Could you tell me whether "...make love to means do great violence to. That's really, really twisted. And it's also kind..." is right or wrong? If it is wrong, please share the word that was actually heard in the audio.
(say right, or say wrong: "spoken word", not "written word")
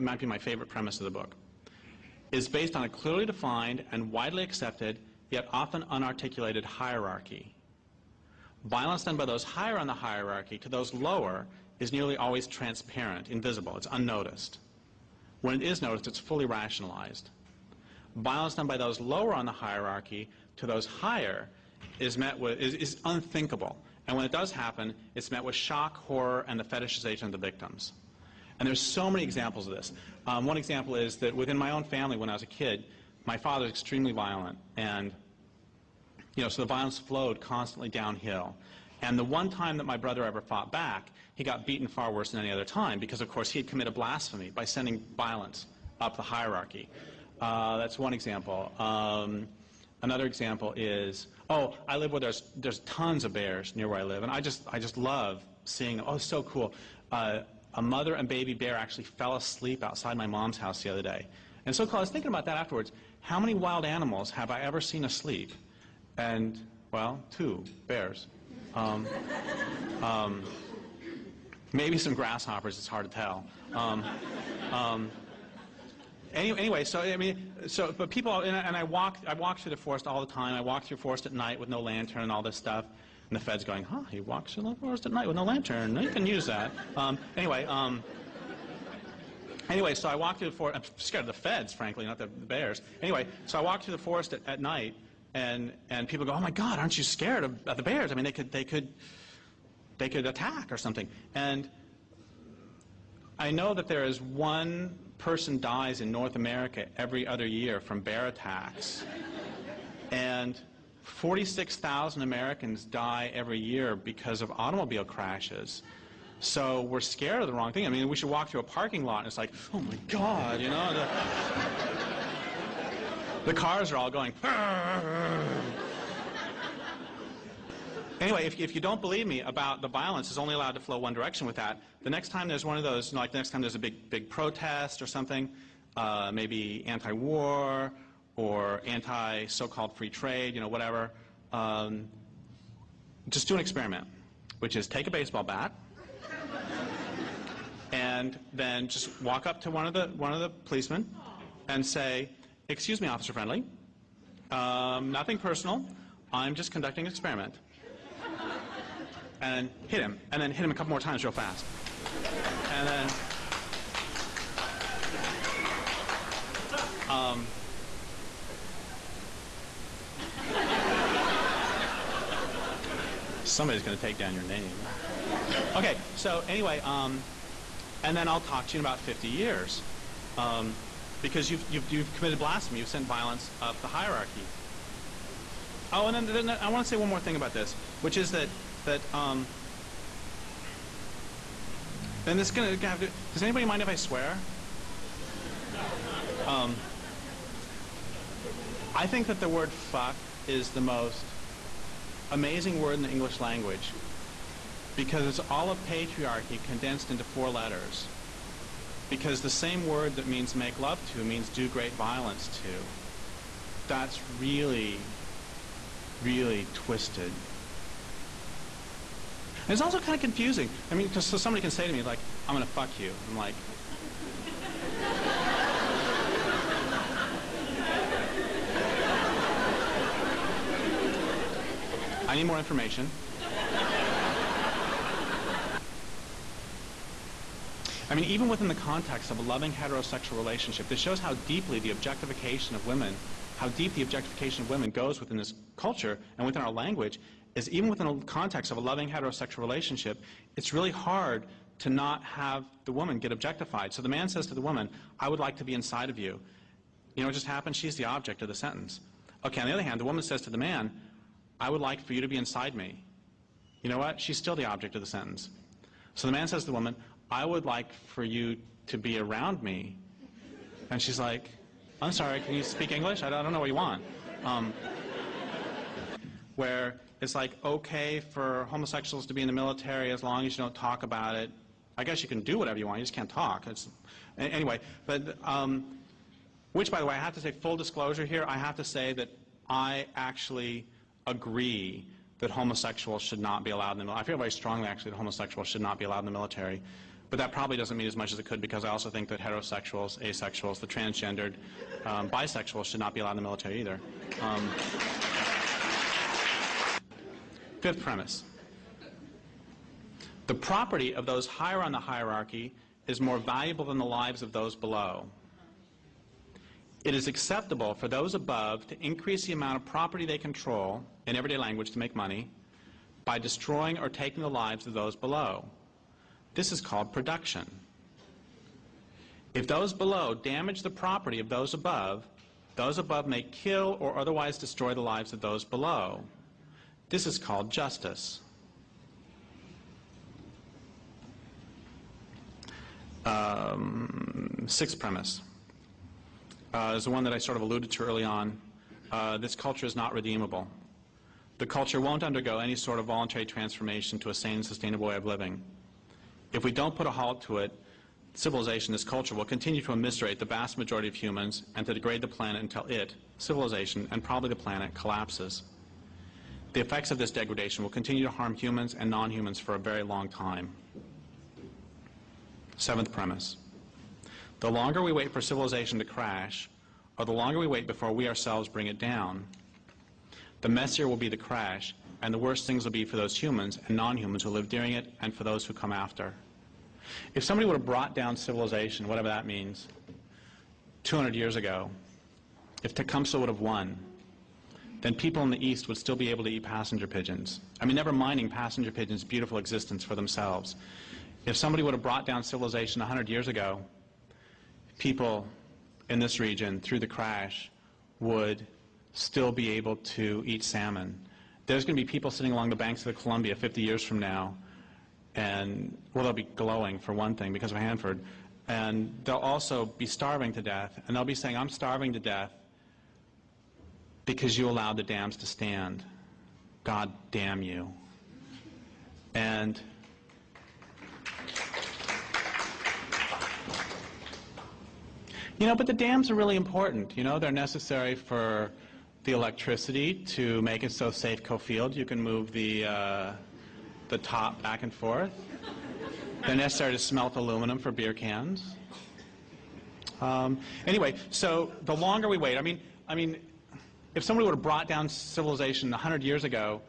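right.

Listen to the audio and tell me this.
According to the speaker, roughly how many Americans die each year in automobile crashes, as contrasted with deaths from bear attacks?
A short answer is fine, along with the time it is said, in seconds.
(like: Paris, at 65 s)
46,000, at 111 s.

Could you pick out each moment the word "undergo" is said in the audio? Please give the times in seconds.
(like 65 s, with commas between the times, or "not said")
352 s.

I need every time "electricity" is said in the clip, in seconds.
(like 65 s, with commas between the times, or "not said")
439 s.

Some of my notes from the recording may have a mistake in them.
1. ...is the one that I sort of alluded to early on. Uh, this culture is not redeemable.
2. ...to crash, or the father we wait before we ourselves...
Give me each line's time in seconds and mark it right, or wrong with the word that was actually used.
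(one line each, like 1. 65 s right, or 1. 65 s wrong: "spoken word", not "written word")
1. 346 s right
2. 375 s wrong: "longer", not "father".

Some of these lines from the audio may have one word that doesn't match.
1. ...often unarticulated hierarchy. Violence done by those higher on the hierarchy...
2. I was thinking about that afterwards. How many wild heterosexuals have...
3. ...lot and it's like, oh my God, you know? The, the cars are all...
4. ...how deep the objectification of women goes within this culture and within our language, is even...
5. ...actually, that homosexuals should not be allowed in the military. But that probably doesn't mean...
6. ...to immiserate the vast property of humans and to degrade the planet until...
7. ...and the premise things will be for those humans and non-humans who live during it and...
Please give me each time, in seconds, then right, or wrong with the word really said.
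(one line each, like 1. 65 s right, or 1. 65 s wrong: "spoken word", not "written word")
1. 5 s right
2. 61 s wrong: "animals", not "heterosexuals"
3. 119 s right
4. 243 s right
5. 294 s right
6. 359 s wrong: "majority", not "property"
7. 382 s wrong: "worse", not "premise".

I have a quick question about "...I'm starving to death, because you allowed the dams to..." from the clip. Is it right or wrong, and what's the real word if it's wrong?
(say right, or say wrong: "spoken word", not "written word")
right.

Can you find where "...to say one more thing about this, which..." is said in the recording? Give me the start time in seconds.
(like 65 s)
186 s.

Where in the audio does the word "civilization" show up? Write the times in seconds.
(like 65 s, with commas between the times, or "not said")
358 s, 363 s, 375 s, 388 s, 402 s, 455 s.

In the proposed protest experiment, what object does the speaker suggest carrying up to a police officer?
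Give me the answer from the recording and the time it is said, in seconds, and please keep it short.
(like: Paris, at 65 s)
A baseball bat, at 145 s.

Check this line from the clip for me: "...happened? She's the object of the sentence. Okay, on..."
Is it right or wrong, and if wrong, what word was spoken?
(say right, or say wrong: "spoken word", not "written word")
right.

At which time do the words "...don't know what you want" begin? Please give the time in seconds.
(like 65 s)
273 s.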